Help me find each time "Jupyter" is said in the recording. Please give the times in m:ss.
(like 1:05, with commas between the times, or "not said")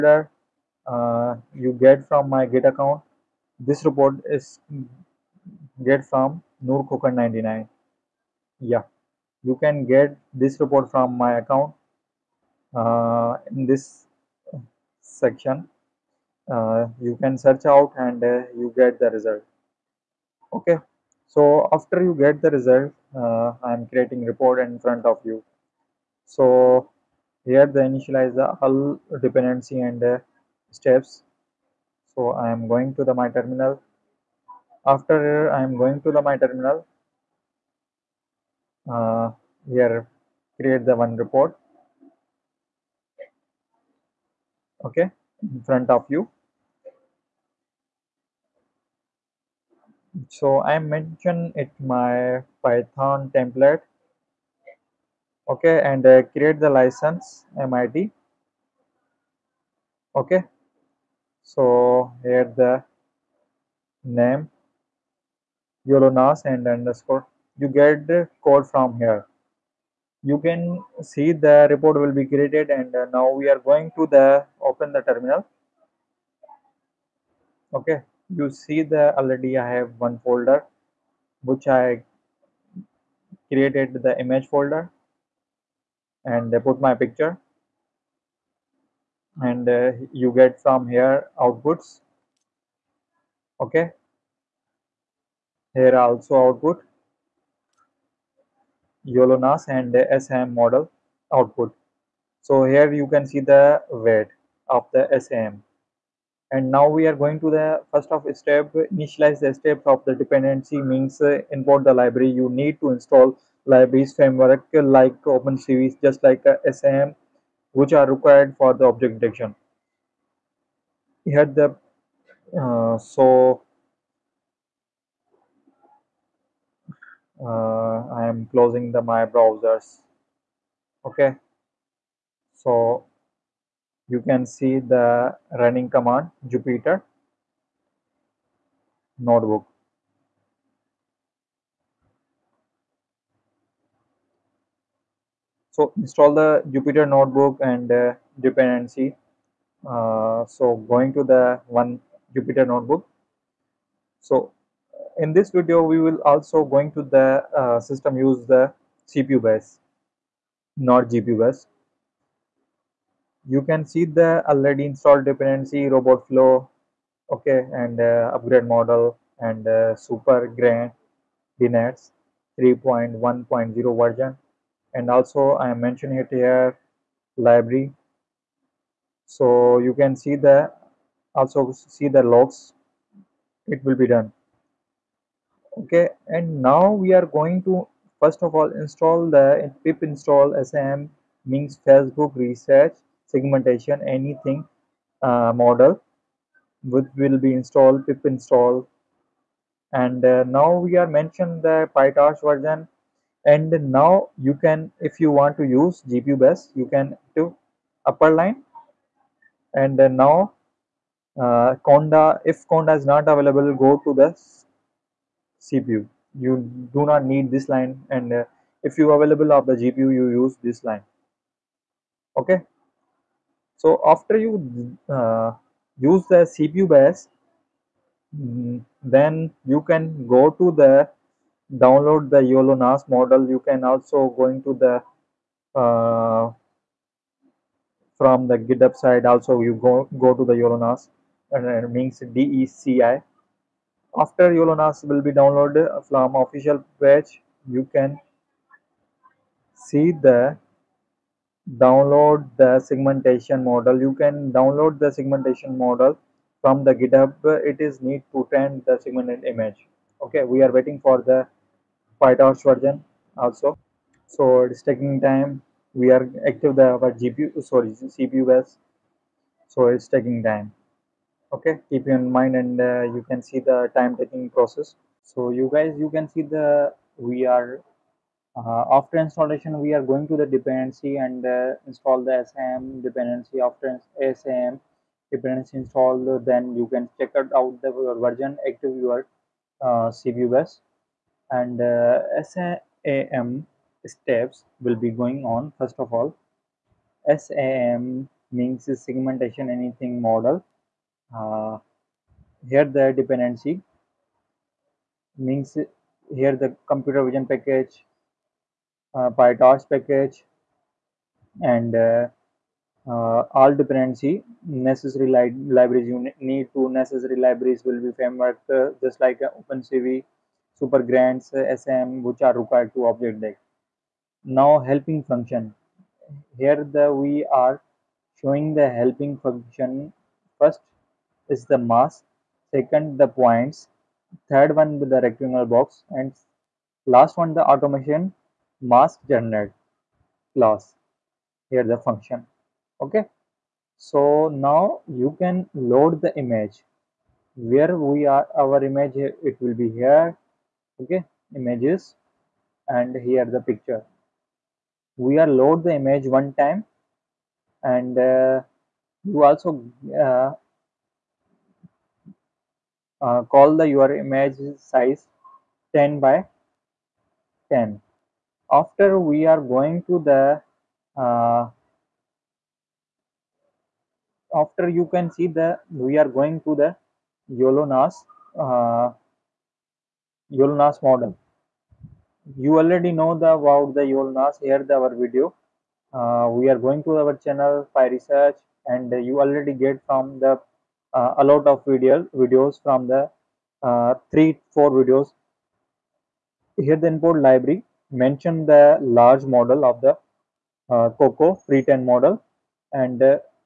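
2:16, 2:26, 2:32.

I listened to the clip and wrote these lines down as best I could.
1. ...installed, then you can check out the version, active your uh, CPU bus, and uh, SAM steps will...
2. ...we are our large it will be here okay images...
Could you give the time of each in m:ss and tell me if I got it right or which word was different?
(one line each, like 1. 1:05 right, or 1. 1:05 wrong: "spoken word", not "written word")
1. 4:45 right
2. 5:47 wrong: "image", not "large".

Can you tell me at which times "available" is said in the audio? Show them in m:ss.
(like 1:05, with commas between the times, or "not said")
3:33, 3:39.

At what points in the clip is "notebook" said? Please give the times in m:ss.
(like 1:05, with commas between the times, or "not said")
2:19, 2:27, 2:32.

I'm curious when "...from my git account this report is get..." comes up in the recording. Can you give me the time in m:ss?
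0:02.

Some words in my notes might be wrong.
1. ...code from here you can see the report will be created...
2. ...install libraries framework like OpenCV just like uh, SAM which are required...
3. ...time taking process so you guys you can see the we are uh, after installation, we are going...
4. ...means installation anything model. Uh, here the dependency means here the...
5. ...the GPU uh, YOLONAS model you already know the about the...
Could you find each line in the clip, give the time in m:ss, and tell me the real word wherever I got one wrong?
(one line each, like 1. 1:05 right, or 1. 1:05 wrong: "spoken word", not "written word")
1. 1:08 right
2. 1:52 right
3. 4:33 right
4. 4:58 wrong: "segmentation", not "installation"
5. 6:16 wrong: "YOLONAS", not "GPU".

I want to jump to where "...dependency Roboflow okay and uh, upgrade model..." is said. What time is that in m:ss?
2:45.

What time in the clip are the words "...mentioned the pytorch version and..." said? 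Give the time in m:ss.
3:21.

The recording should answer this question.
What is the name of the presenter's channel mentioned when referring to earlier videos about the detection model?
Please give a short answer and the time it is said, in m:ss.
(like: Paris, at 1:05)
PyResearch, at 6:27.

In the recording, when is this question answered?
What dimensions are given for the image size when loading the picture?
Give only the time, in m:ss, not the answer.
6:05.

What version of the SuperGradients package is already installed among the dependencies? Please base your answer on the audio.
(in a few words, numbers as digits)
3.1.0.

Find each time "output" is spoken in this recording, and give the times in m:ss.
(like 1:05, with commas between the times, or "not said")
1:31, 1:36, 1:41.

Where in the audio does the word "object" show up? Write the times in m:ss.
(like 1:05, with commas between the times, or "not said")
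1:58, 5:23.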